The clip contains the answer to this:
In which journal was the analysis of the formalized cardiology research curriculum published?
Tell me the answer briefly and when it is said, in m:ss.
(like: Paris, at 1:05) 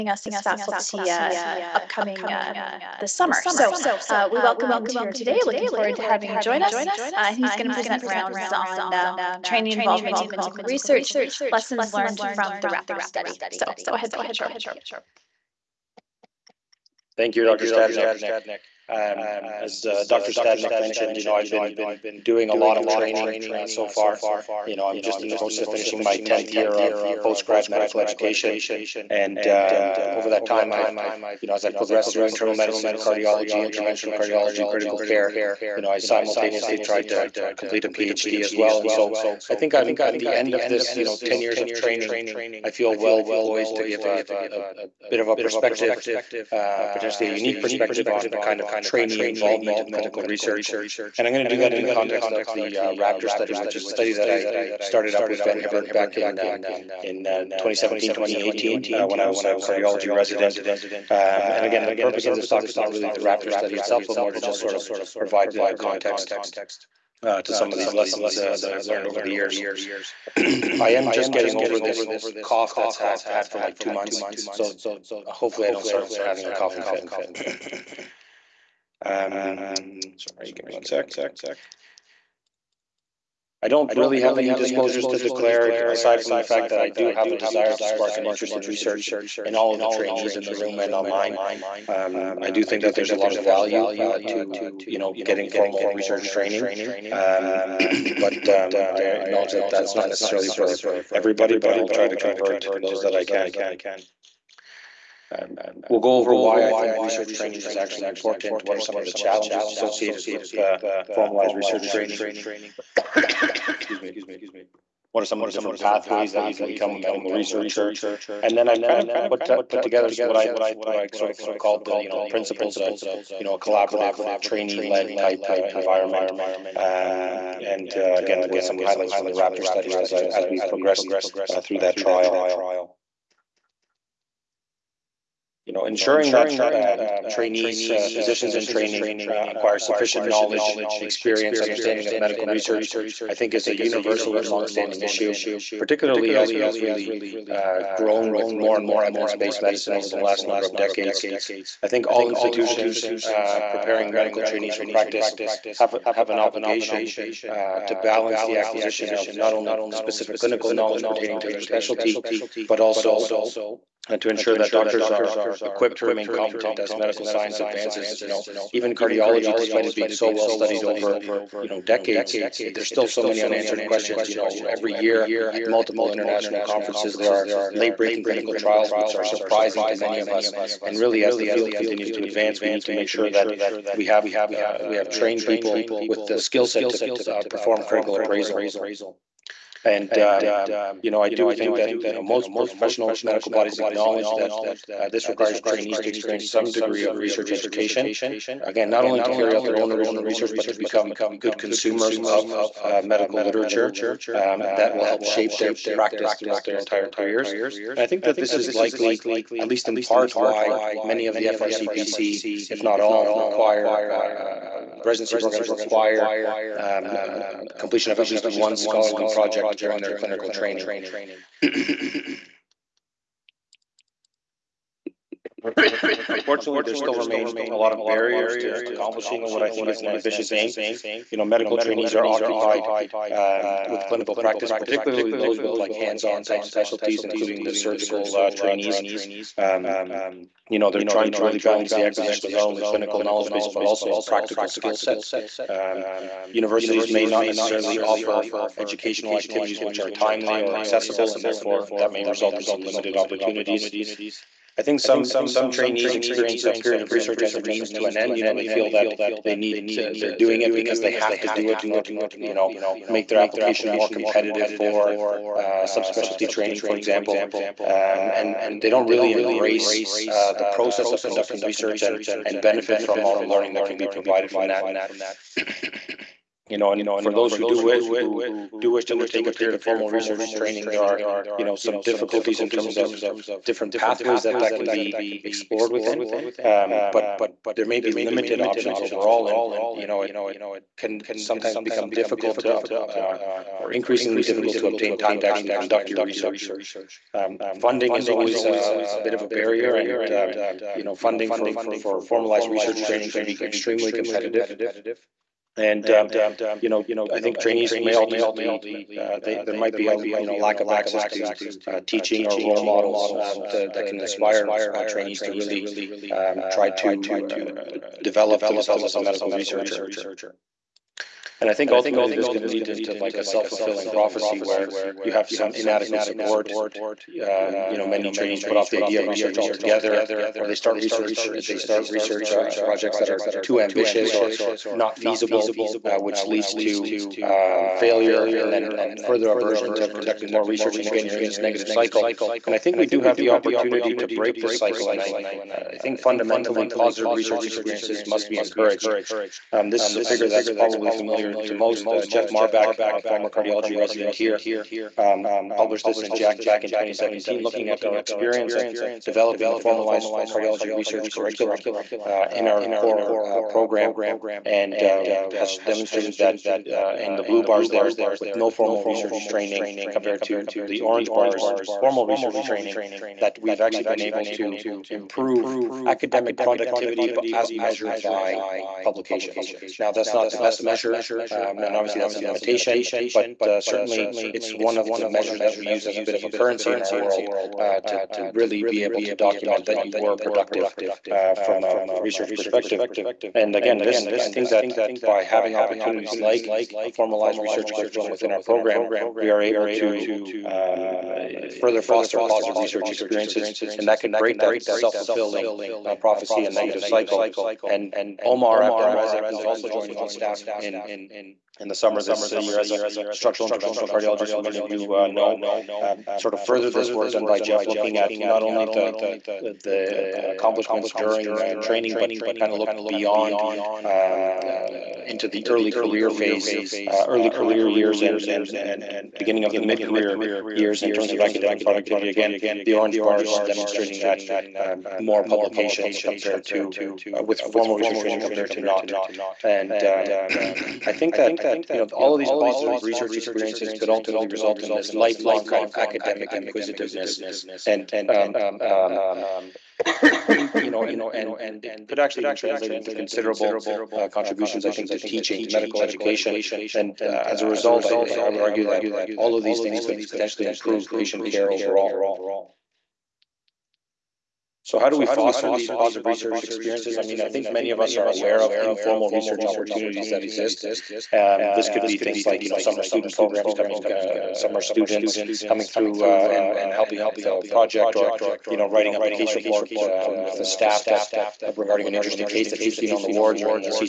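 JACC, at 5:56.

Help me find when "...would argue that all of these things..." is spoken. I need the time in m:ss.
7:38.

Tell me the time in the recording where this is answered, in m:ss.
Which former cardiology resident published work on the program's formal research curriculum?
5:52.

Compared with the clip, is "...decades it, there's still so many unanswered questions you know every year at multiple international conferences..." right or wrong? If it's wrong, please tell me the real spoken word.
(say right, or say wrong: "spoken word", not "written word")
right.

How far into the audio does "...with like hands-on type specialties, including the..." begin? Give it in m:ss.
3:55.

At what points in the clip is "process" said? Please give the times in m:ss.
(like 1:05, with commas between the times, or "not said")
0:25, 4:30.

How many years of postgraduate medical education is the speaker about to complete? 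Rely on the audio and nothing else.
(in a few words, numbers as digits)
10th year.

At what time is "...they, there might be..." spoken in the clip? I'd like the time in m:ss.
5:09.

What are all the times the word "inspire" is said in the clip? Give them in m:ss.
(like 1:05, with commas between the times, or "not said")
5:14.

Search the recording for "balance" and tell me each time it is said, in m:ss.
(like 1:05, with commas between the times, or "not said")
2:37, 4:01.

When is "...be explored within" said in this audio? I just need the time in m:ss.
4:44.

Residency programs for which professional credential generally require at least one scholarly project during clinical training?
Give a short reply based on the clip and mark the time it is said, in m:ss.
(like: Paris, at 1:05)
FRCPC, at 3:31.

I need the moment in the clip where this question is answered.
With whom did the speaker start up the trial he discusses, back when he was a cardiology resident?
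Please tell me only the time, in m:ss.
0:55.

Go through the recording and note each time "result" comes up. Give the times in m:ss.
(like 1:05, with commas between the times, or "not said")
4:12, 7:24, 7:37.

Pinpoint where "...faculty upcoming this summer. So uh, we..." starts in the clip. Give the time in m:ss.
0:00.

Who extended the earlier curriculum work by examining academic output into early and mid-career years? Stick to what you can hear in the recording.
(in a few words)
Omar Abdel-Razek.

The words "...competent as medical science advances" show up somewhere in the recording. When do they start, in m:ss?
2:46.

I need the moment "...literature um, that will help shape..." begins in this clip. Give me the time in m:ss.
3:23.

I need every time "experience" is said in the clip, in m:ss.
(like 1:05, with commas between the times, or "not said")
2:20, 3:16, 4:16, 5:47, 5:58, 6:43, 7:23, 7:46.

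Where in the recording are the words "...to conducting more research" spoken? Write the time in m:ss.
5:39.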